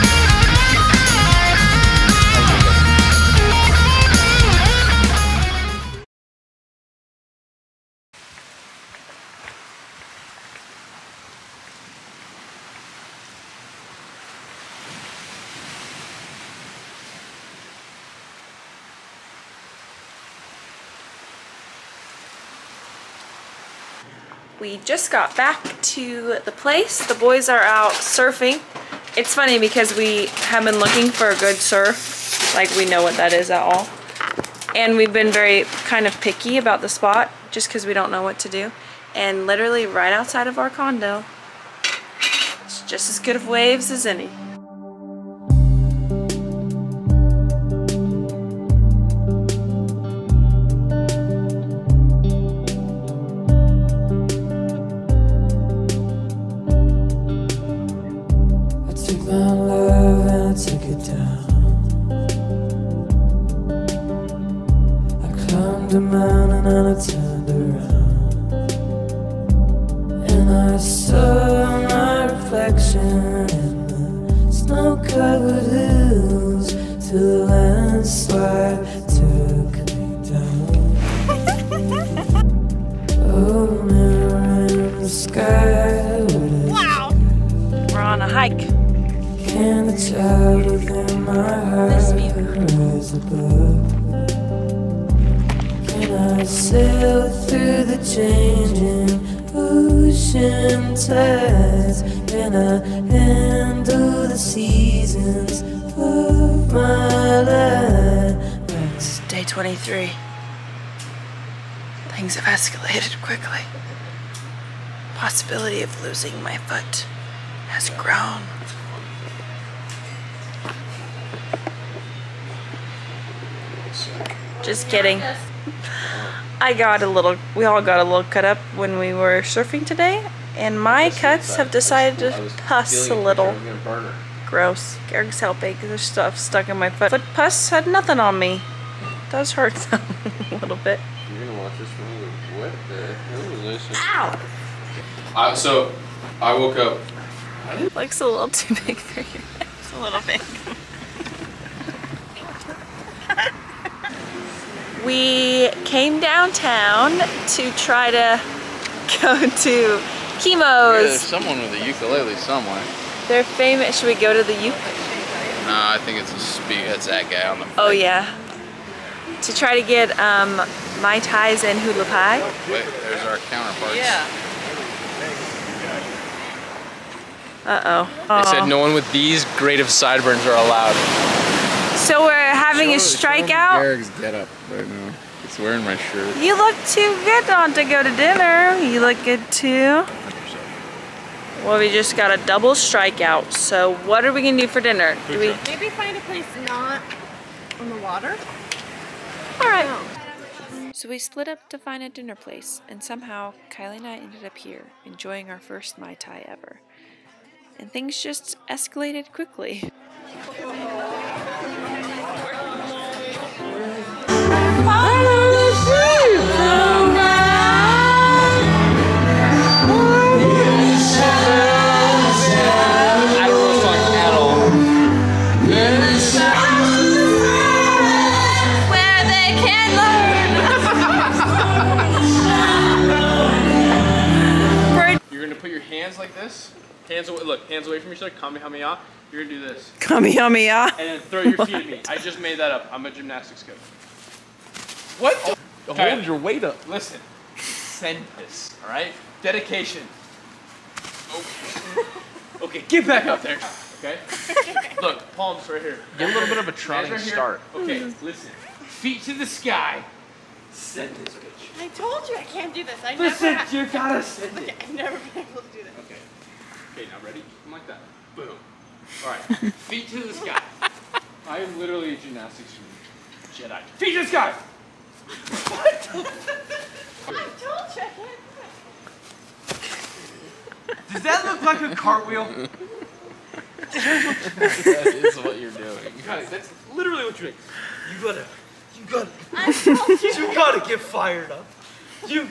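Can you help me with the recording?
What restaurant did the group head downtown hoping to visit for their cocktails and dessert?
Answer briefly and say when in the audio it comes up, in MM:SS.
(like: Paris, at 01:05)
Kimo's, at 02:40.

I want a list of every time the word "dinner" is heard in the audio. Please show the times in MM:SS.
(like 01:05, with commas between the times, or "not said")
03:08, 03:14, 03:22.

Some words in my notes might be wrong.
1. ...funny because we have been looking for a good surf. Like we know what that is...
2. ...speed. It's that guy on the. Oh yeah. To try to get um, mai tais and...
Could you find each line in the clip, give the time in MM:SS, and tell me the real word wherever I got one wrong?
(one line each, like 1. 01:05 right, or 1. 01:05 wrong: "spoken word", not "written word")
1. 00:29 right
2. 02:46 right.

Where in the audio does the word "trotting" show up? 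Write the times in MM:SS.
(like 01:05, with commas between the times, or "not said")
04:16.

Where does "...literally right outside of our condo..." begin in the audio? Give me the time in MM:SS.
00:39.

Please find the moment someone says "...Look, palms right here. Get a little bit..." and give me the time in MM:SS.
04:15.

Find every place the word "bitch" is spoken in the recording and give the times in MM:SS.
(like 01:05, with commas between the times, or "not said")
04:21.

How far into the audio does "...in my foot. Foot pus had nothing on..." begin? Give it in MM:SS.
02:16.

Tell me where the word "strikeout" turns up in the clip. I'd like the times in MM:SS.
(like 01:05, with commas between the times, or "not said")
03:02, 03:12.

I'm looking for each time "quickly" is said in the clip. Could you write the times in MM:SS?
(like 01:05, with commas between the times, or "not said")
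01:53, 03:29.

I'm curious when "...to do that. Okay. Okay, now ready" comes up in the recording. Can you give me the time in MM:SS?
04:25.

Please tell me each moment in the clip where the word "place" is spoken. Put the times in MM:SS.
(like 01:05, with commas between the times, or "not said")
00:26, 03:16, 03:22.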